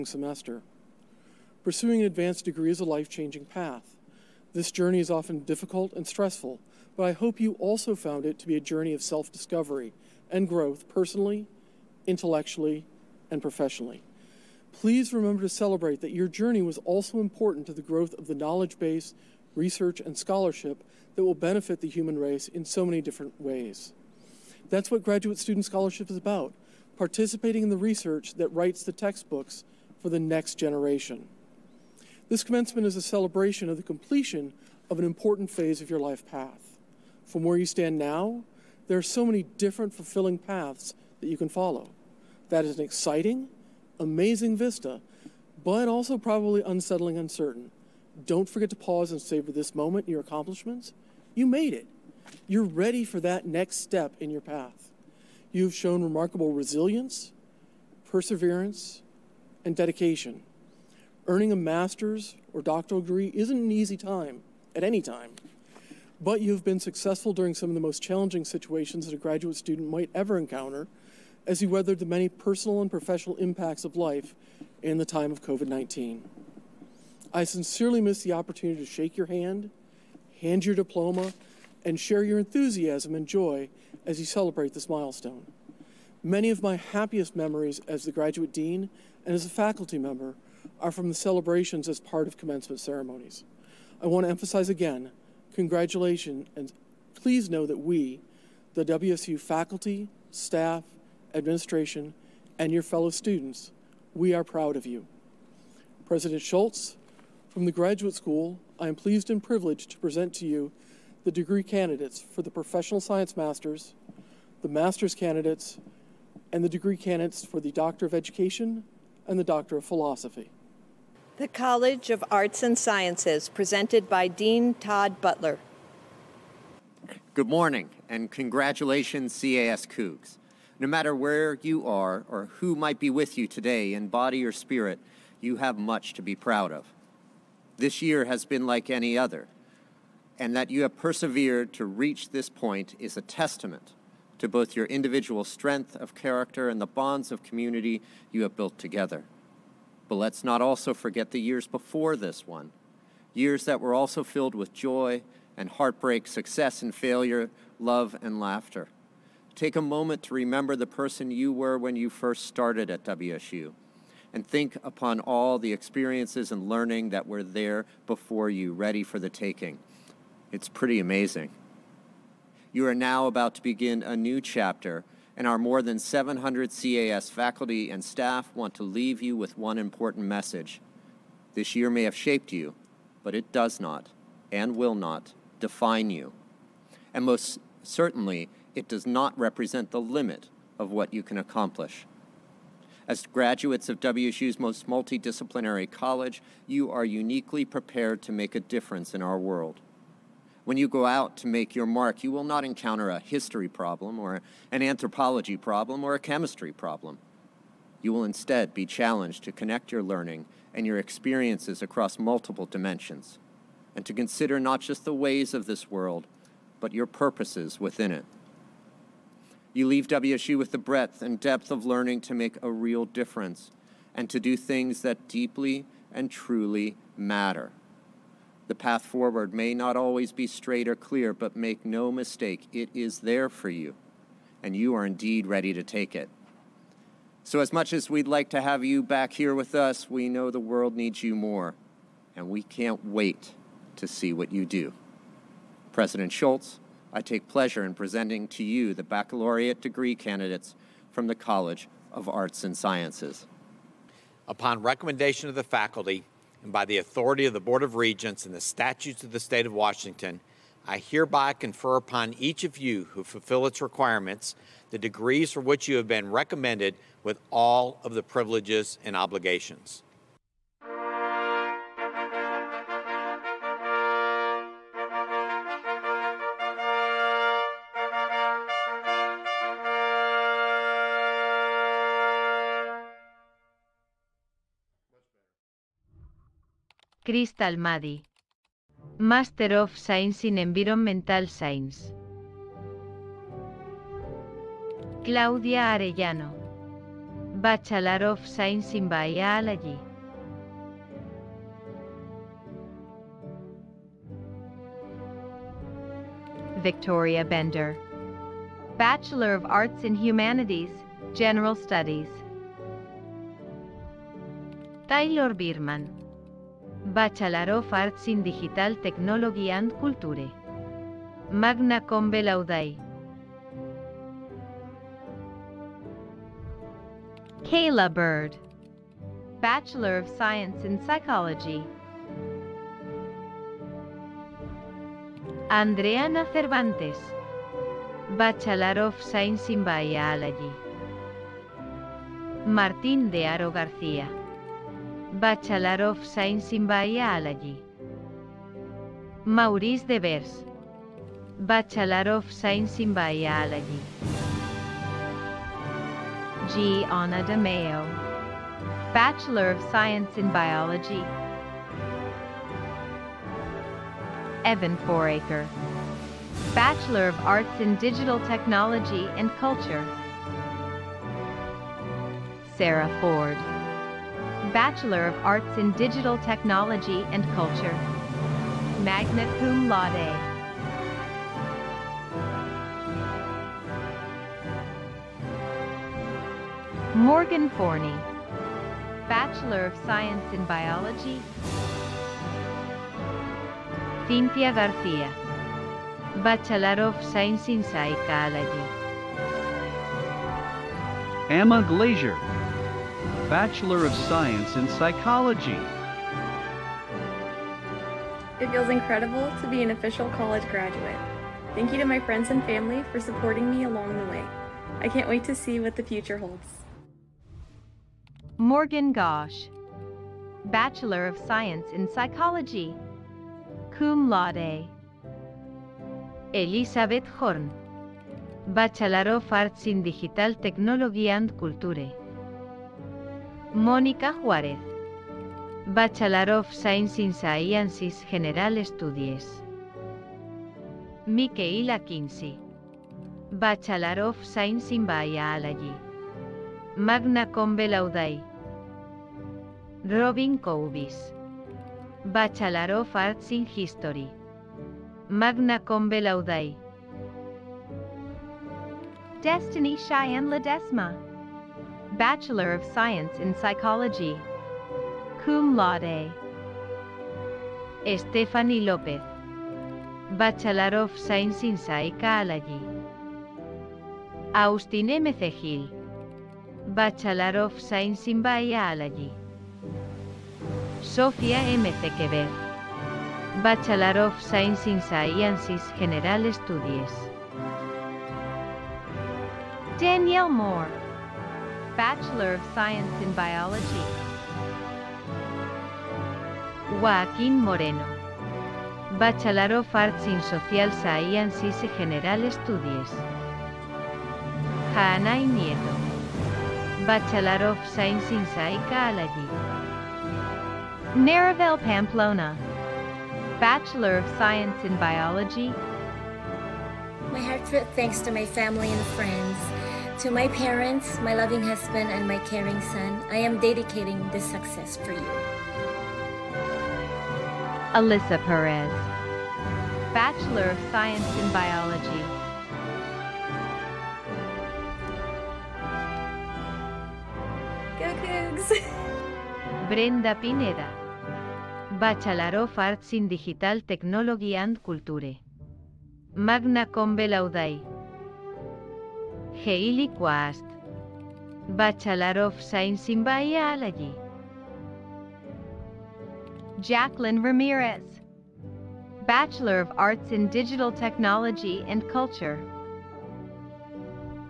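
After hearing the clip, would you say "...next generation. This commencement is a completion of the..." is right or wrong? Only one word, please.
wrong.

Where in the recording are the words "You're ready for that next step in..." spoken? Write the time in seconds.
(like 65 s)
52 s.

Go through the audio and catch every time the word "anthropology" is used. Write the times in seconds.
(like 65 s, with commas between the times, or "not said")
204 s.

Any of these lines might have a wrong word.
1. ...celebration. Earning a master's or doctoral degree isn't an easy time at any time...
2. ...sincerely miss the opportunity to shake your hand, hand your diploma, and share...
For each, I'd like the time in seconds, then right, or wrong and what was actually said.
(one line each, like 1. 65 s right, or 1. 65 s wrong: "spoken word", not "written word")
1. 59 s wrong: "dedication", not "celebration"
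2. 77 s right.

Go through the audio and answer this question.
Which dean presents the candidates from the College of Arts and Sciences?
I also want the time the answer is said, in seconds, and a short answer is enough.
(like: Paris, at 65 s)
Todd Butler, at 124 s.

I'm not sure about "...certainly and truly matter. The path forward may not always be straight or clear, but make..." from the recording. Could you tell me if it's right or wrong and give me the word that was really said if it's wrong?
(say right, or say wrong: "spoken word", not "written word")
wrong: "deeply", not "certainly".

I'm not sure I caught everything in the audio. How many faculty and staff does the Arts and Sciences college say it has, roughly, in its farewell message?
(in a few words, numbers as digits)
More than 700.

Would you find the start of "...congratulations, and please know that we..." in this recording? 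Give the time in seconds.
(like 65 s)
95 s.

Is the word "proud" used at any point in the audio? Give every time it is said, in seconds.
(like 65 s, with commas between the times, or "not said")
104 s, 136 s.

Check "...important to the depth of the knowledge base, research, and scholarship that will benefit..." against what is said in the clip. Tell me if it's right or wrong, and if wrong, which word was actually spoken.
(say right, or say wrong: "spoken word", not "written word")
wrong: "growth", not "depth".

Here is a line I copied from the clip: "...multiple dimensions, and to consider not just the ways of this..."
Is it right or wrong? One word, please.
right.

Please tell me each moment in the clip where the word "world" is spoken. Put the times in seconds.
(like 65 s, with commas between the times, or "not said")
199 s, 215 s, 240 s.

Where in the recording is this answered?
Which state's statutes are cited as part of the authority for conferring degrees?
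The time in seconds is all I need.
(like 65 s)
259 s.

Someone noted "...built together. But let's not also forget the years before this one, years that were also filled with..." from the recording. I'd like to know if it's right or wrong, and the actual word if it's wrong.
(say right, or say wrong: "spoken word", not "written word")
right.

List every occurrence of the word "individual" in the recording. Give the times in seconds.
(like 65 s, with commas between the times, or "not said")
144 s.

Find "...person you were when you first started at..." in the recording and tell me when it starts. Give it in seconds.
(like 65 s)
160 s.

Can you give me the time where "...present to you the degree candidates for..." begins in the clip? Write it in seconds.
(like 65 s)
109 s.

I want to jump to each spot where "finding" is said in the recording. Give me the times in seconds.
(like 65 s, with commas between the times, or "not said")
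not said.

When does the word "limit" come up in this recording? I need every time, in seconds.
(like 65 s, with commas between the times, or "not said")
189 s.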